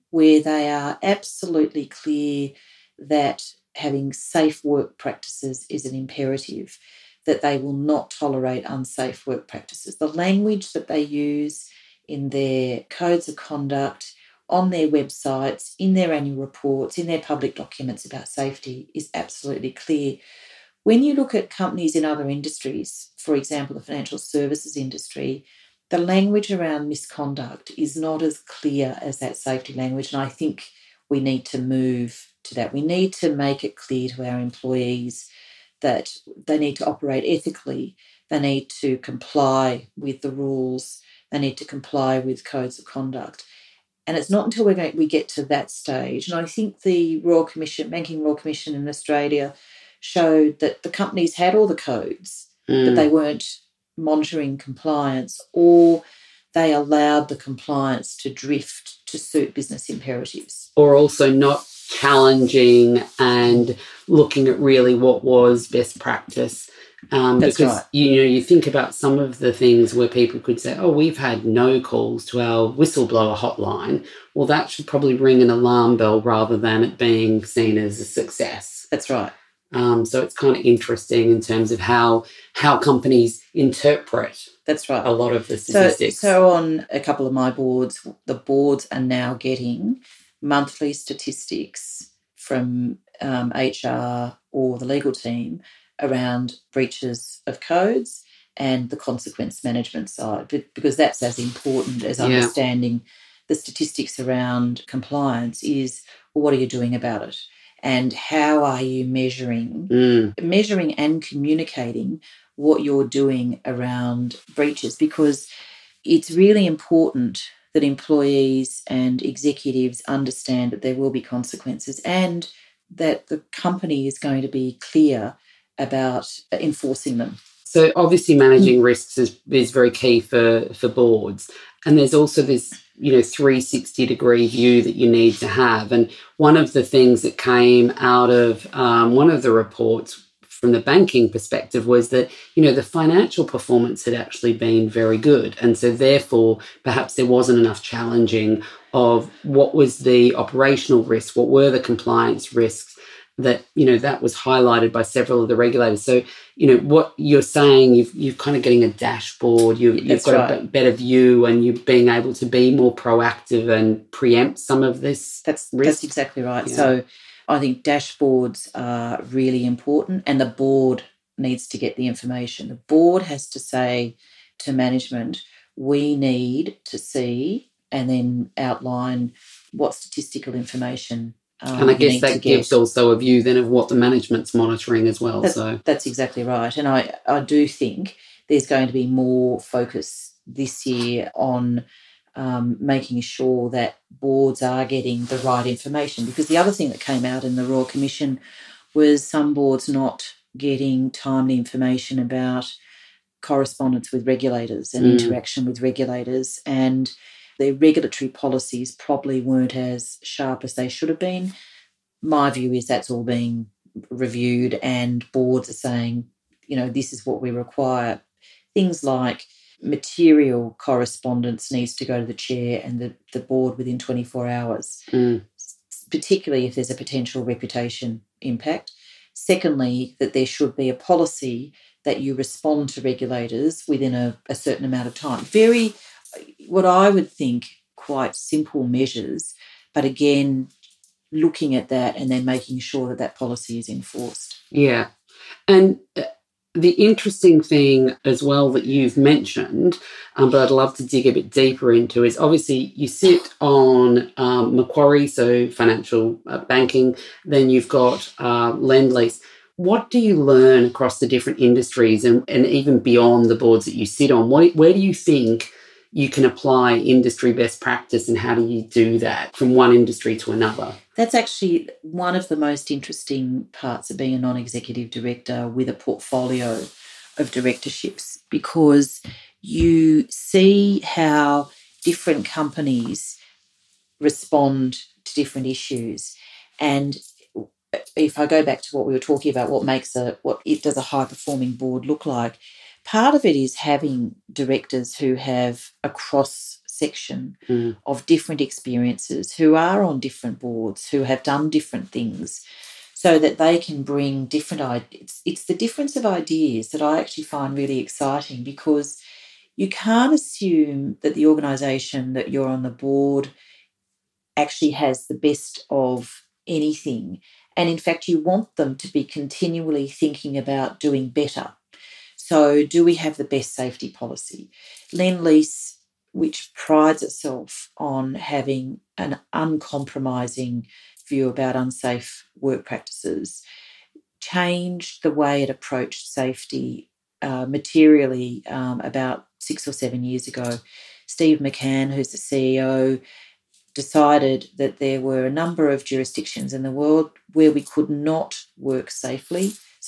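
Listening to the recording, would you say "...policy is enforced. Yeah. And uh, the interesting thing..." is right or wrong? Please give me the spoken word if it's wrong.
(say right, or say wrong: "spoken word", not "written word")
right.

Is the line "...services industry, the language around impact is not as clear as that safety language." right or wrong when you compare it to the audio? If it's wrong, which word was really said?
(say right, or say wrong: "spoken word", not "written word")
wrong: "misconduct", not "impact".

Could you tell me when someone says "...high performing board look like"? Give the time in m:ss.
4:51.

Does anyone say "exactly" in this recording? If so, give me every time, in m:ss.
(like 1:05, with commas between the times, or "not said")
2:46, 3:06.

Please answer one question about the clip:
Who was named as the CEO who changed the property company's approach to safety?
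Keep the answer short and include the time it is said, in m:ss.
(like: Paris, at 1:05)
Steve McCann, at 5:41.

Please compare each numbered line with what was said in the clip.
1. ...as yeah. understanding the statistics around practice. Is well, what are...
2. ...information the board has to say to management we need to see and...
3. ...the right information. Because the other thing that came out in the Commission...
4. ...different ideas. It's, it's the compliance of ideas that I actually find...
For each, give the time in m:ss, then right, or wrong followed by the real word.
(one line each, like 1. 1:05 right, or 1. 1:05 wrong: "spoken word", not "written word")
1. 1:42 wrong: "compliance", not "practice"
2. 2:52 right
3. 3:15 wrong: "Royal", not "Commission"
4. 5:04 wrong: "difference", not "compliance".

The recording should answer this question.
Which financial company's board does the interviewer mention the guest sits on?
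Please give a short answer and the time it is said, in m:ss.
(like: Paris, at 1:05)
Macquarie, at 4:14.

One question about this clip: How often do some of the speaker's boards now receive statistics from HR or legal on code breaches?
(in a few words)
Monthly.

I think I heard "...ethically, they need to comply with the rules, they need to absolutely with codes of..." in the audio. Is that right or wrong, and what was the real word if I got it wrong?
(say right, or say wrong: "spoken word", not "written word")
wrong: "comply", not "absolutely".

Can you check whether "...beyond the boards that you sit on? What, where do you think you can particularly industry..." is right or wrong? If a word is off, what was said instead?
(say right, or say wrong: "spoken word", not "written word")
wrong: "apply", not "particularly".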